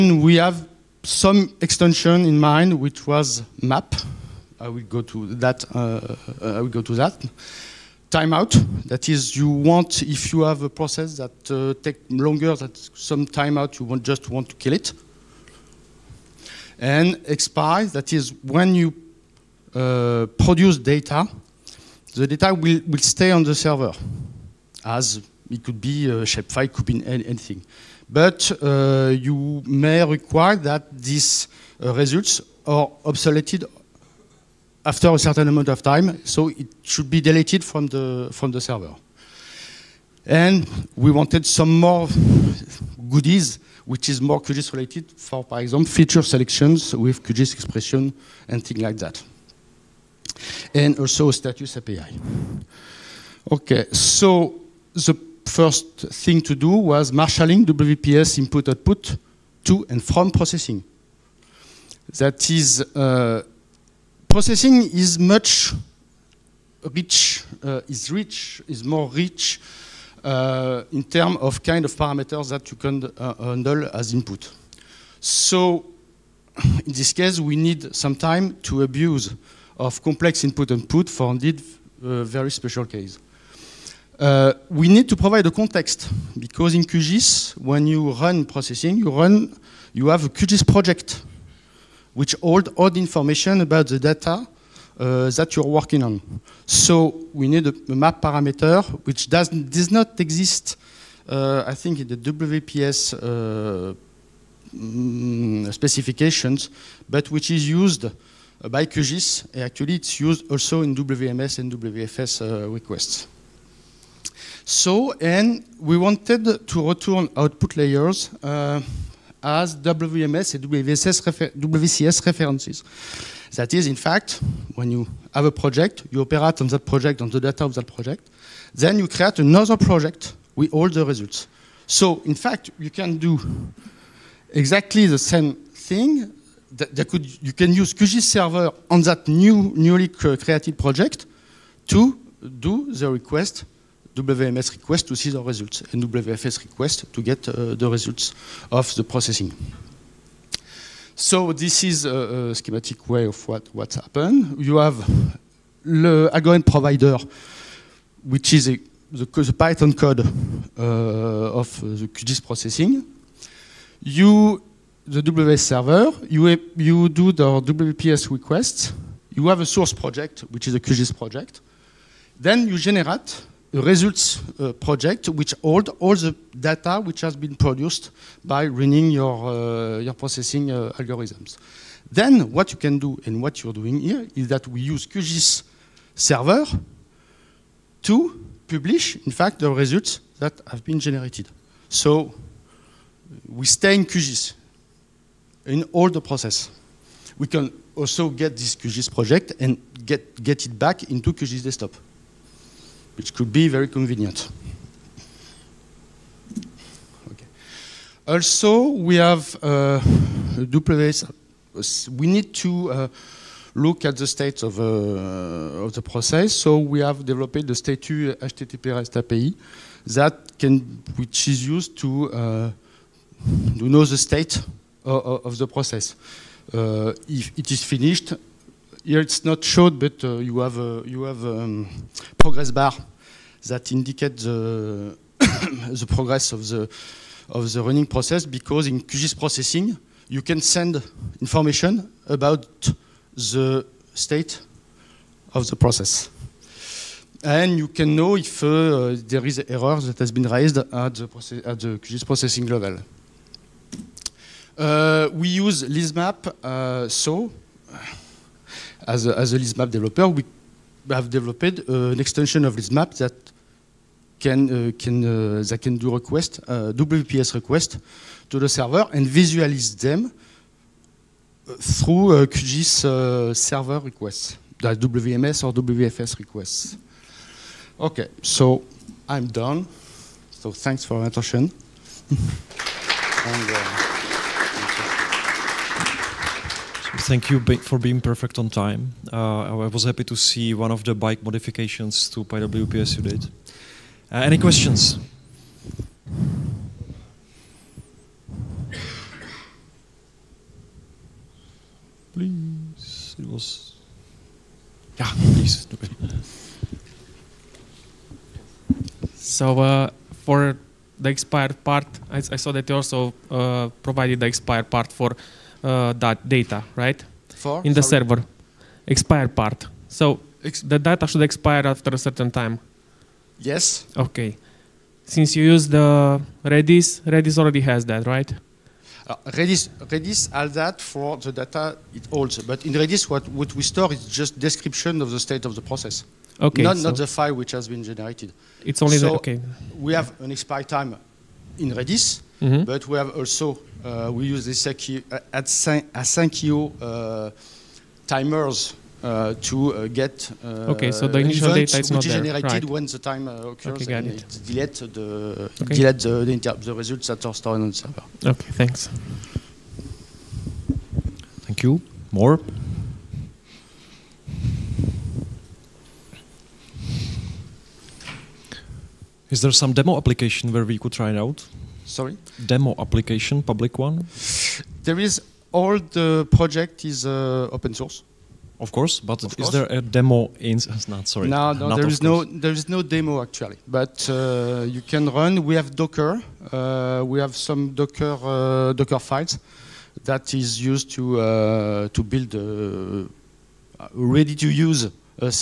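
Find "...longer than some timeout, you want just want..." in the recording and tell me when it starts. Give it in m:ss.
0:12.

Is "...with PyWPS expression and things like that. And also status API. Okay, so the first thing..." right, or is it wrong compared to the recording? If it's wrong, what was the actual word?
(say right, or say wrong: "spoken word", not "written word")
wrong: "QGIS", not "PyWPS".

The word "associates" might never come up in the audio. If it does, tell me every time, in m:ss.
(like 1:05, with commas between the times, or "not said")
not said.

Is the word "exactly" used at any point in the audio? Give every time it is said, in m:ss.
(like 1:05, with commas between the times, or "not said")
2:14.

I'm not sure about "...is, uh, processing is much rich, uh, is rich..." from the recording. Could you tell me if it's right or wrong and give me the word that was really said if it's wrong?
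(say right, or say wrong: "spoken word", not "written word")
right.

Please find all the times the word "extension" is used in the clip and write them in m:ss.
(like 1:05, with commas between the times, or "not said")
0:01, 4:22.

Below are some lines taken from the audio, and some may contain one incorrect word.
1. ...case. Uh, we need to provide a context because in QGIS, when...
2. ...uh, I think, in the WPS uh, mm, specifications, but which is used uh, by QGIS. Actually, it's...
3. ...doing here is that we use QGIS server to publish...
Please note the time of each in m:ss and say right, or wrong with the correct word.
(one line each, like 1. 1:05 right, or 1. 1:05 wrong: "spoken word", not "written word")
1. 1:22 right
2. 1:41 right
3. 3:03 right.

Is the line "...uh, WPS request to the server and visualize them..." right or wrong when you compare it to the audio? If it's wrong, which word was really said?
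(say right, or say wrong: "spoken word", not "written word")
right.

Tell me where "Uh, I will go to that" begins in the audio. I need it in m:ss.
0:05.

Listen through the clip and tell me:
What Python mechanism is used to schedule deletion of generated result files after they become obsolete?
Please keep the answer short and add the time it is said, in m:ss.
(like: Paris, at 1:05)
asyncio timers, at 5:46.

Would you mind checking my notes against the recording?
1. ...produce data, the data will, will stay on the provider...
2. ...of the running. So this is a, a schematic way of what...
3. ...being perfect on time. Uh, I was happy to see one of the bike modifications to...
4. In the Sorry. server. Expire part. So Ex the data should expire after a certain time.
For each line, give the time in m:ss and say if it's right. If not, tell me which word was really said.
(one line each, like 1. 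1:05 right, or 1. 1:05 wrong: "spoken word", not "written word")
1. 0:20 wrong: "server", not "provider"
2. 2:28 wrong: "processing", not "running"
3. 4:47 right
4. 5:17 right.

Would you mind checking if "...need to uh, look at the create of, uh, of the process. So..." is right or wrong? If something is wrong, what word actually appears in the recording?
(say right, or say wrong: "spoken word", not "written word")
wrong: "state", not "create".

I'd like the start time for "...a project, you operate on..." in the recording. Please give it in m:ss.
2:05.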